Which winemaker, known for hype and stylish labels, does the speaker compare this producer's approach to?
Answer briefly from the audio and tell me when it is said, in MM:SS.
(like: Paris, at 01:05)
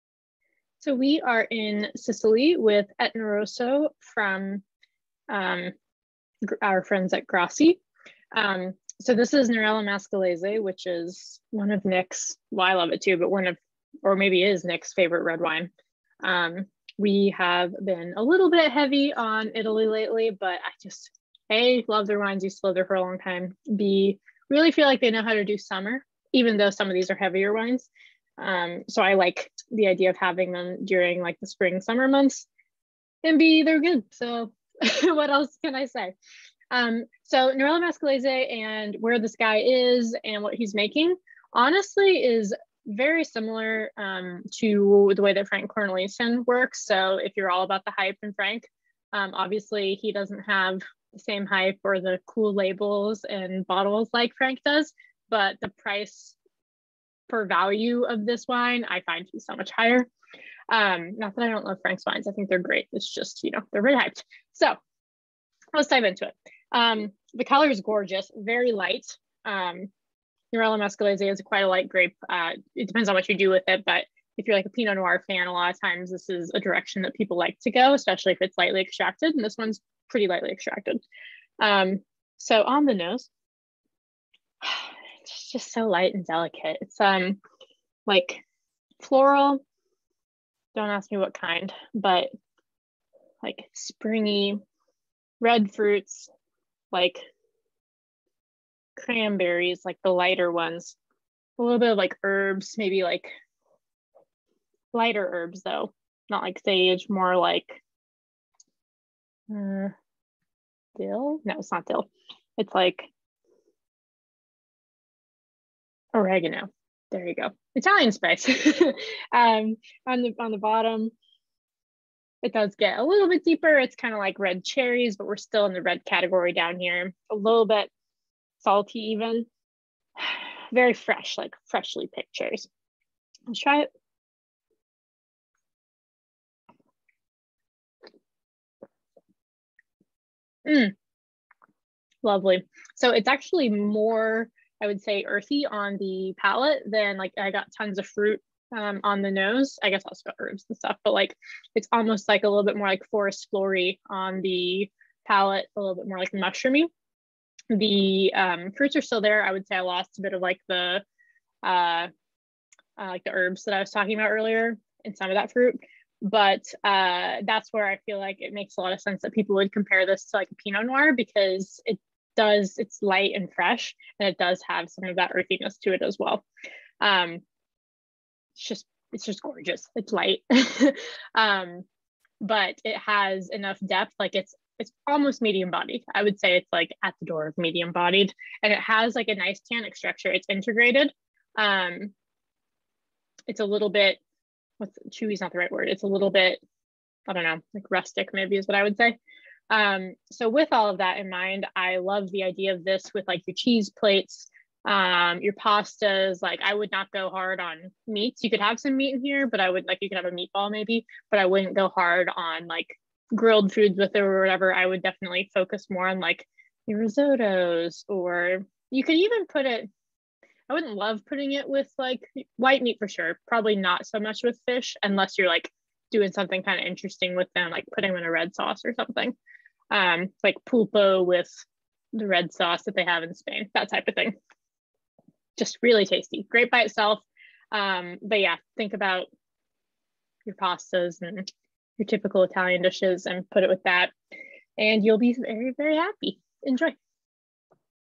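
Frank Cornelissen, at 00:45.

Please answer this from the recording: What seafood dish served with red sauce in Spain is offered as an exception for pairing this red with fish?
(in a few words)
pulpo.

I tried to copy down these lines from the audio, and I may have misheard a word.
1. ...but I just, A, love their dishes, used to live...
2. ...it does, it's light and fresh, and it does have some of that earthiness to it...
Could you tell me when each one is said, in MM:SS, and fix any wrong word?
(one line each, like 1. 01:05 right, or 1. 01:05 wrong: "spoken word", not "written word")
1. 00:20 wrong: "wines", not "dishes"
2. 02:51 right.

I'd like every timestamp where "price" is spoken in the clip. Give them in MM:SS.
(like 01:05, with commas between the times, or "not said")
00:55.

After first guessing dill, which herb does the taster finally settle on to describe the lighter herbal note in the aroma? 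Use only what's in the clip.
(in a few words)
oregano.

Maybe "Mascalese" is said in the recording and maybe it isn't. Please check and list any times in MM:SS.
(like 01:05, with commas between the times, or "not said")
00:09, 00:37, 01:10.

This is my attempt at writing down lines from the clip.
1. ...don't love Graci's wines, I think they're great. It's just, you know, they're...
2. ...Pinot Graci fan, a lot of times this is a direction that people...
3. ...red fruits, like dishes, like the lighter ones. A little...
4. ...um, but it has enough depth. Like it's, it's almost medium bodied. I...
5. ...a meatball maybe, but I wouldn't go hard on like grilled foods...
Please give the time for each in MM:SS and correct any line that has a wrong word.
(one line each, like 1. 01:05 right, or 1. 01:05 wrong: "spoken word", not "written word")
1. 01:01 wrong: "Frank", not "Graci"
2. 01:14 wrong: "Noir", not "Graci"
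3. 01:35 wrong: "cranberries", not "dishes"
4. 03:01 right
5. 03:30 right.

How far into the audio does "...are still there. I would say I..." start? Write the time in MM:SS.
02:38.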